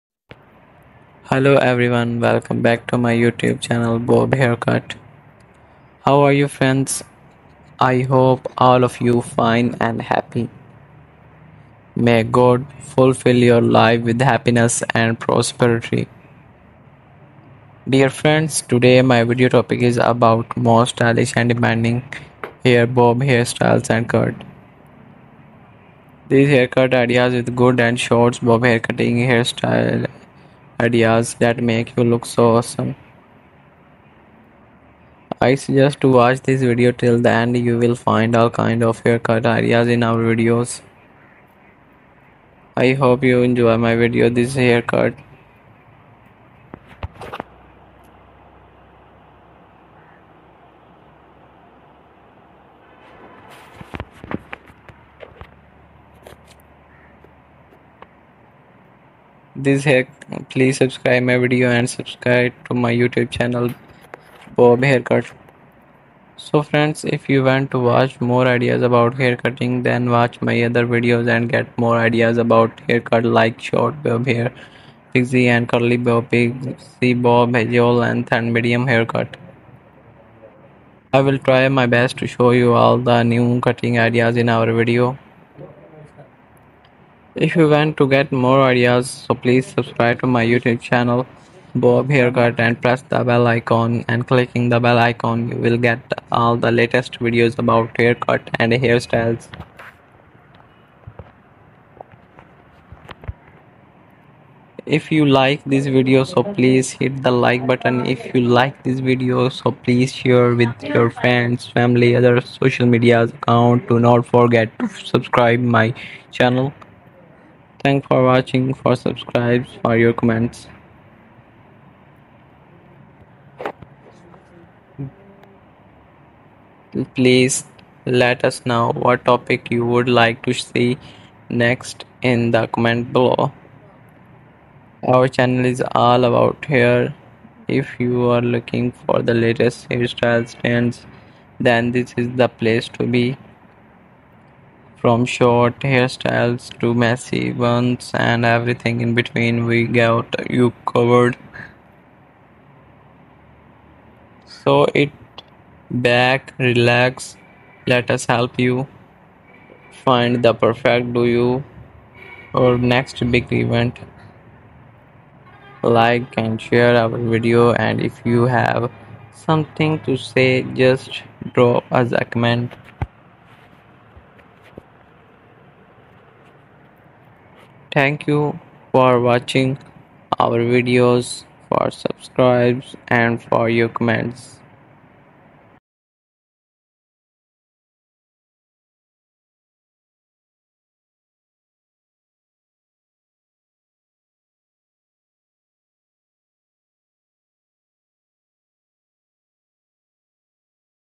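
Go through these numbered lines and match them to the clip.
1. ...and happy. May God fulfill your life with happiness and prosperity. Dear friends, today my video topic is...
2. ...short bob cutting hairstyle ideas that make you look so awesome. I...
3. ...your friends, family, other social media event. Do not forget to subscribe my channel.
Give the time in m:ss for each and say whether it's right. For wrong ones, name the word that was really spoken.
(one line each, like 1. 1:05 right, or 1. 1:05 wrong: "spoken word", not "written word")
1. 0:09 right
2. 0:27 wrong: "haircutting", not "cutting"
3. 1:50 wrong: "account", not "event".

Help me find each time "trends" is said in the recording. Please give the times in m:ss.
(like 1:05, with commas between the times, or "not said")
2:20.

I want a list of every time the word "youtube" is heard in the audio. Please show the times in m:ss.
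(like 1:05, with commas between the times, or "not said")
0:03, 1:02, 1:30.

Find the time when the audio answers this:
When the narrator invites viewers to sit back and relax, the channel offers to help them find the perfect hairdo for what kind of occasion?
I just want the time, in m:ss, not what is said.
2:42.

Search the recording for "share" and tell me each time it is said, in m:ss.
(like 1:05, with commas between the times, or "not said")
1:50, 2:46.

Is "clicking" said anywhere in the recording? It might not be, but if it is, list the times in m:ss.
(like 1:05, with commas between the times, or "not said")
1:34.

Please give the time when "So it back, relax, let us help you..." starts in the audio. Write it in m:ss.
2:34.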